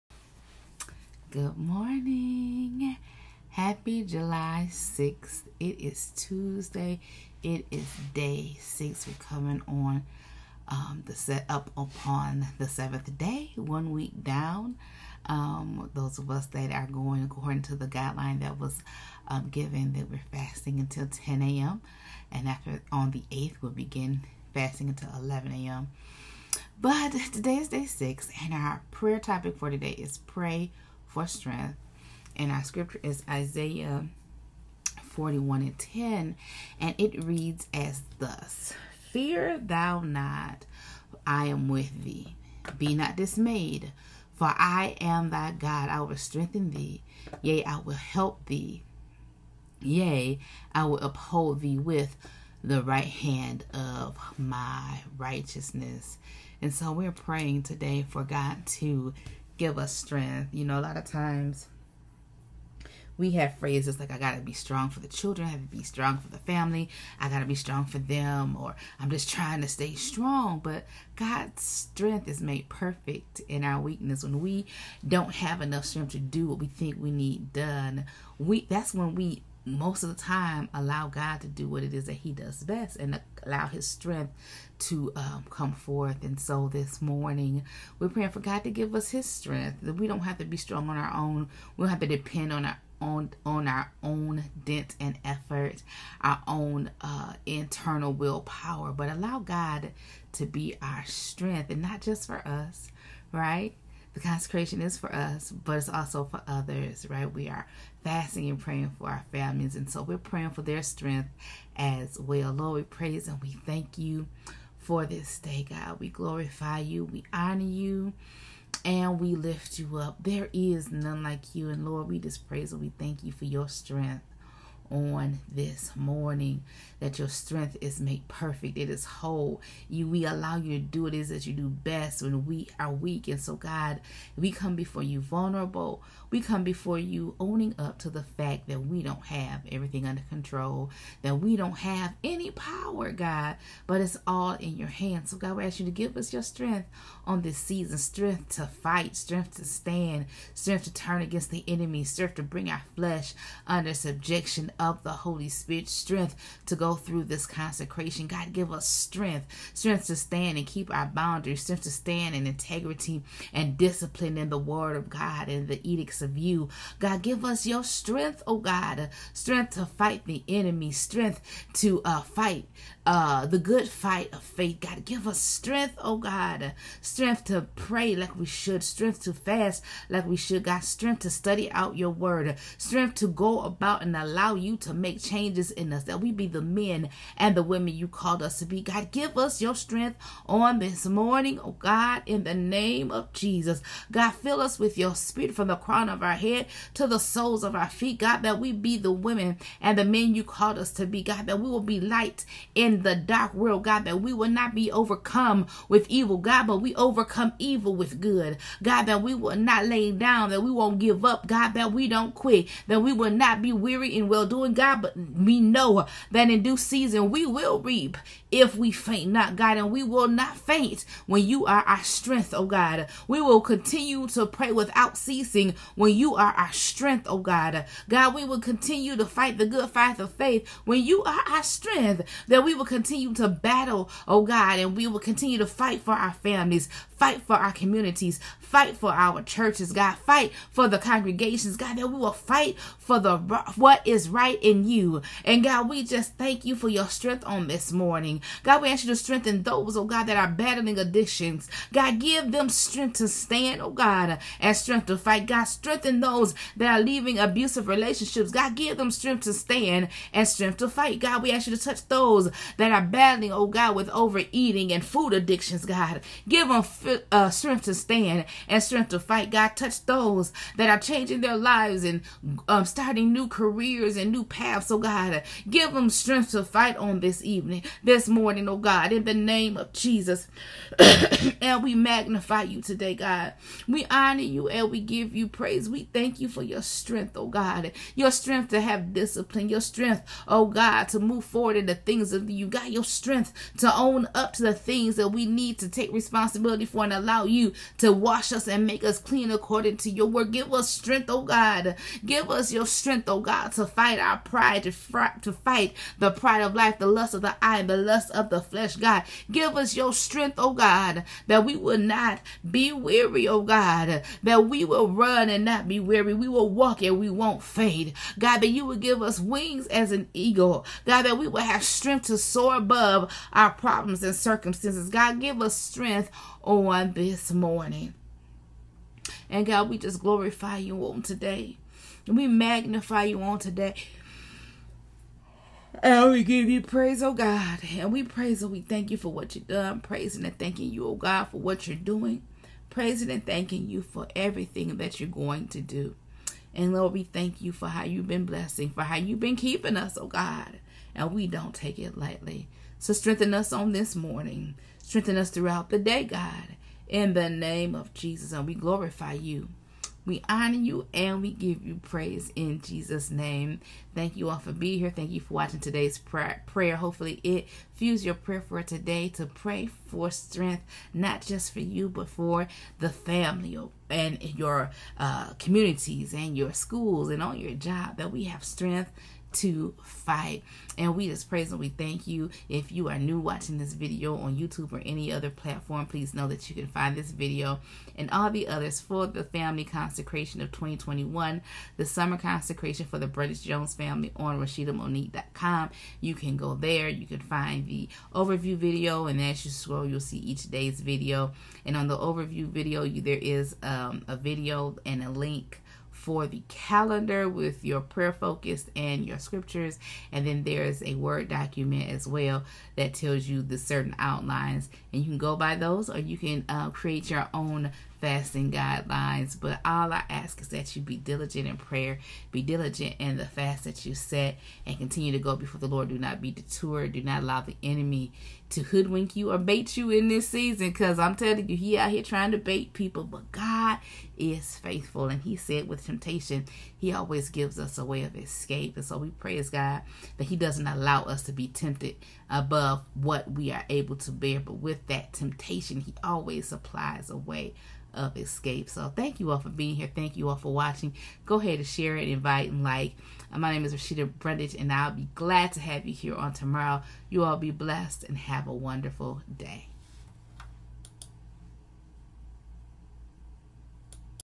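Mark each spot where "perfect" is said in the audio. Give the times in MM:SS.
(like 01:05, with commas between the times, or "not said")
01:12, 02:08.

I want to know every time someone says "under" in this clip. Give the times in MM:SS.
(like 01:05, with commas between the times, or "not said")
02:20, 02:33.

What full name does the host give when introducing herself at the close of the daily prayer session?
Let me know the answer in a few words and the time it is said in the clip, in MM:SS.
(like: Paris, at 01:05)
Roscheeta Brundage, at 07:33.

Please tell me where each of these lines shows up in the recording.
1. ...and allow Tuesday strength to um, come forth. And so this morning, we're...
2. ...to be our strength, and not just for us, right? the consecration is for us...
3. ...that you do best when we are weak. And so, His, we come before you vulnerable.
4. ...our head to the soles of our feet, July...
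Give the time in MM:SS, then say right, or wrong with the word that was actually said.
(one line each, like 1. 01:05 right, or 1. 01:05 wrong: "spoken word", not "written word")
1. 01:22 wrong: "His", not "Tuesday"
2. 01:40 right
3. 02:11 wrong: "God", not "His"
4. 03:16 wrong: "God", not "July".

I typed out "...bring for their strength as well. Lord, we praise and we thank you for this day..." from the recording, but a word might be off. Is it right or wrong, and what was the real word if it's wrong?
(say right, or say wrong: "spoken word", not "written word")
wrong: "praying", not "bring".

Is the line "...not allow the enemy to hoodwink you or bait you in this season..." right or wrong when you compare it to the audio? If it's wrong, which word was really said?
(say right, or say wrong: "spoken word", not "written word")
right.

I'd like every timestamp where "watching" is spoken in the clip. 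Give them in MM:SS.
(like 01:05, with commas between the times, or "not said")
06:05, 06:23, 07:30.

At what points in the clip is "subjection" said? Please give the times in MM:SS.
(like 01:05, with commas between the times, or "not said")
02:33.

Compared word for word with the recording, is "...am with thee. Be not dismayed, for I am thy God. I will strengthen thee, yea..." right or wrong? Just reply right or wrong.
right.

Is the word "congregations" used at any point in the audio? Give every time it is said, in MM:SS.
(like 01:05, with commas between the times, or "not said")
04:00.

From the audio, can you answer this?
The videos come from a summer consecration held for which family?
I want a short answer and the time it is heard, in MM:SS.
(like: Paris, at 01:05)
British Jones family, at 06:33.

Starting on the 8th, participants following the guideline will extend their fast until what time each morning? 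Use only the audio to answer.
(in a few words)
11 a.m.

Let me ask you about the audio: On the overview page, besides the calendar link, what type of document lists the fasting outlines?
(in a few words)
Word document.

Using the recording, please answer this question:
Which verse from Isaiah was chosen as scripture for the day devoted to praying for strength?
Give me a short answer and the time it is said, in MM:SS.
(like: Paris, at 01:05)
Isaiah 41:10, at 00:33.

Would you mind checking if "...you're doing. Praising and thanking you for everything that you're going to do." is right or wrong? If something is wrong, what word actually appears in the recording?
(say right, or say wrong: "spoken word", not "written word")
right.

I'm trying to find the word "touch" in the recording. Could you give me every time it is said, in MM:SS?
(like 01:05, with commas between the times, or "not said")
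04:21, 04:29.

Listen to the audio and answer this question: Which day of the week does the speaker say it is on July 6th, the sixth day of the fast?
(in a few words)
Tuesday.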